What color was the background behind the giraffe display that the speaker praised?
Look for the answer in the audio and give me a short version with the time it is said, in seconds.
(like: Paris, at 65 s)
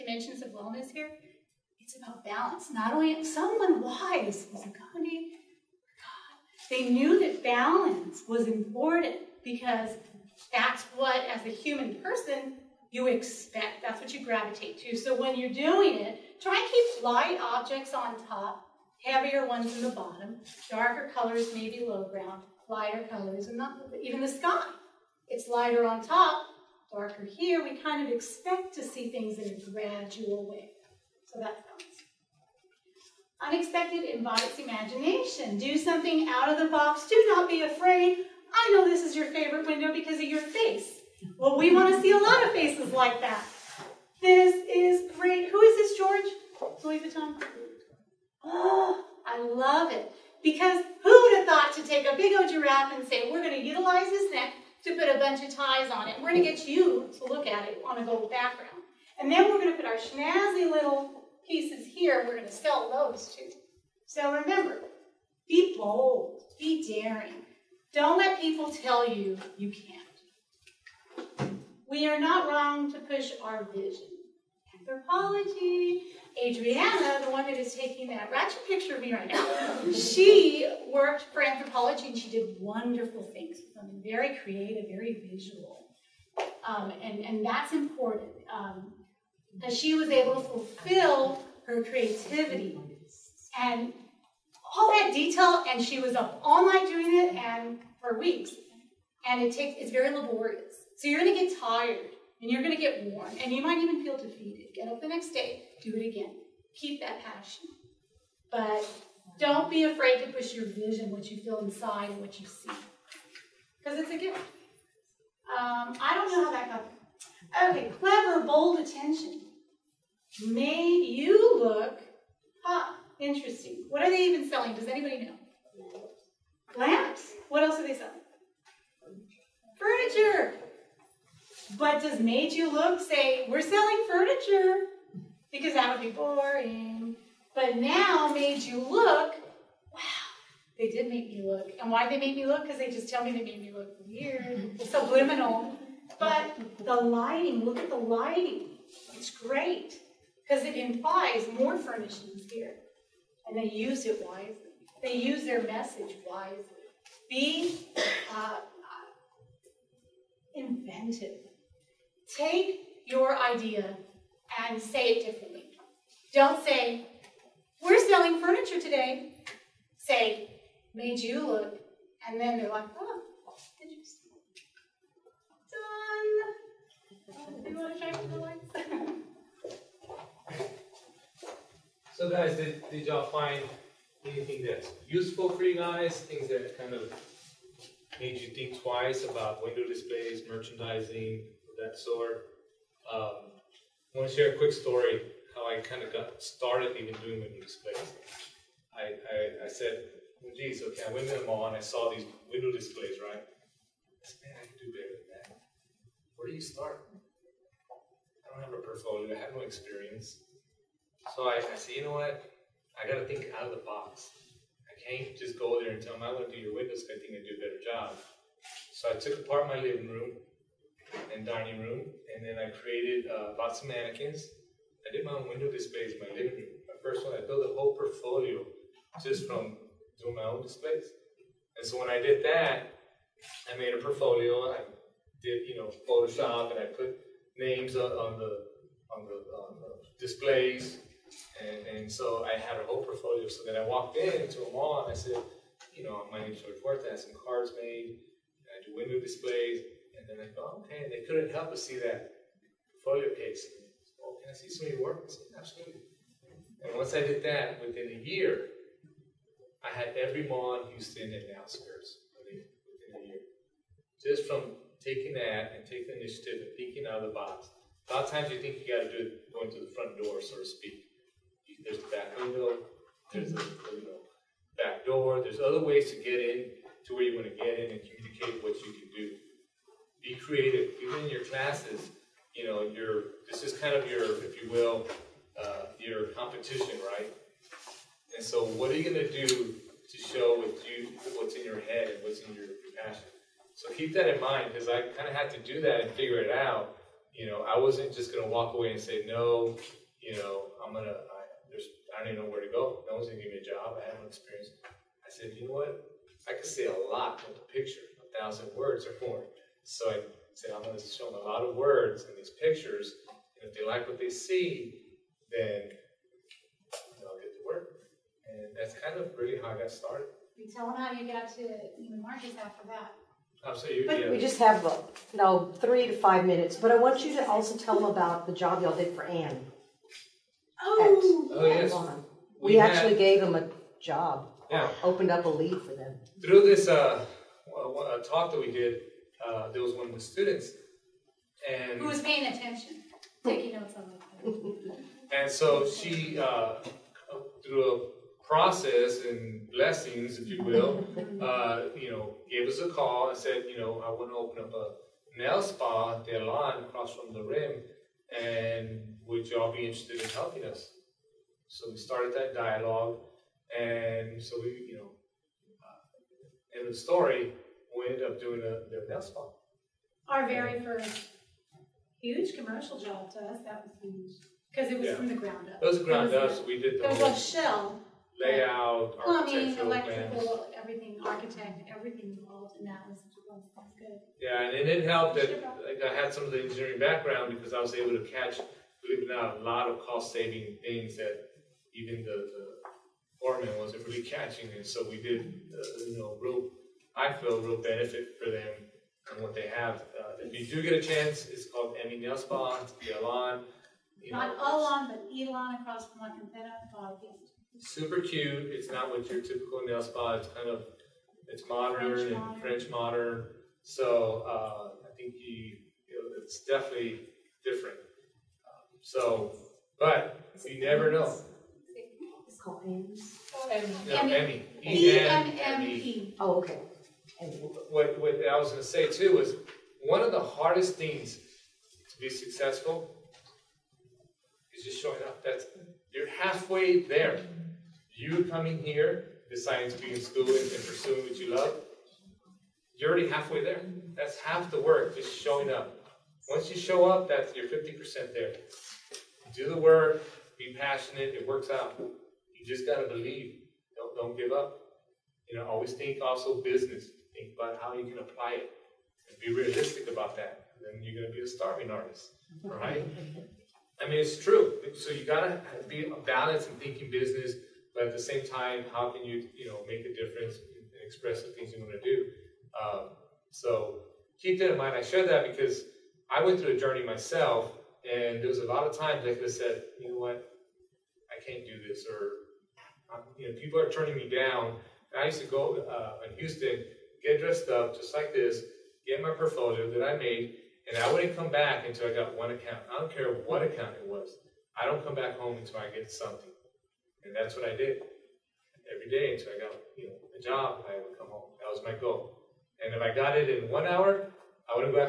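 Gold, at 58 s.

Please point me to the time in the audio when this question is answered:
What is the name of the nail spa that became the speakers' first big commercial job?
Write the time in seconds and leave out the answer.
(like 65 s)
402 s.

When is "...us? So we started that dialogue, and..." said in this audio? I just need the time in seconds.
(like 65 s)
360 s.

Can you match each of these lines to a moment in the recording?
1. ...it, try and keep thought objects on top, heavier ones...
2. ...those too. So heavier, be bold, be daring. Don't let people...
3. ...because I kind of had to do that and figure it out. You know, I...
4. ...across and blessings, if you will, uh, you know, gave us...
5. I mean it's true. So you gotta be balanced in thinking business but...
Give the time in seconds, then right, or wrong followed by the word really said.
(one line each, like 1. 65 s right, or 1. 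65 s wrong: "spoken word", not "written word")
1. 15 s wrong: "light", not "thought"
2. 62 s wrong: "remember", not "heavier"
3. 294 s right
4. 348 s wrong: "process", not "across"
5. 464 s right.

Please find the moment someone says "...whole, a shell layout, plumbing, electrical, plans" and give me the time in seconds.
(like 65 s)
377 s.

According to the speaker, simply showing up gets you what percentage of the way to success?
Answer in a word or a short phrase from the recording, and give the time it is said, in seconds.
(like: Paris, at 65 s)
50%, at 447 s.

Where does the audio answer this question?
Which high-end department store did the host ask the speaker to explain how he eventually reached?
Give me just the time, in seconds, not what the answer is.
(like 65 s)
321 s.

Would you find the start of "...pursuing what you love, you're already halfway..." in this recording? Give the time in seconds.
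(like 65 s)
440 s.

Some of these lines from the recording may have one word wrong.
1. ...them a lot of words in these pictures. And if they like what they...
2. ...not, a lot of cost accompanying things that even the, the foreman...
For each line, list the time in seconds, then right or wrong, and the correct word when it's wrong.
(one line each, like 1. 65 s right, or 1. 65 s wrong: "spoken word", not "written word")
1. 311 s right
2. 389 s wrong: "saving", not "accompanying".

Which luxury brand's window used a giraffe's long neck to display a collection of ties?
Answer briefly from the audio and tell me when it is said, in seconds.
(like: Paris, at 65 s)
Louis Vuitton, at 46 s.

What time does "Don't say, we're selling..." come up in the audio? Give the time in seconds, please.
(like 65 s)
166 s.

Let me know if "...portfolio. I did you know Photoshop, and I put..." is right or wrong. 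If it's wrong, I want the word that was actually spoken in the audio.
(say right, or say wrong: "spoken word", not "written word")
right.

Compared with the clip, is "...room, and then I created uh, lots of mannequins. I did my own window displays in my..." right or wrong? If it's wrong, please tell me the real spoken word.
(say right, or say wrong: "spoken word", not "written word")
right.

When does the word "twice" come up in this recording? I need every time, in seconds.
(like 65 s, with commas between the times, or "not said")
188 s.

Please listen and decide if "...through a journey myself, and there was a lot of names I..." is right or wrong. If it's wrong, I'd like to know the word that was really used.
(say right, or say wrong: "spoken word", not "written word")
wrong: "times", not "names".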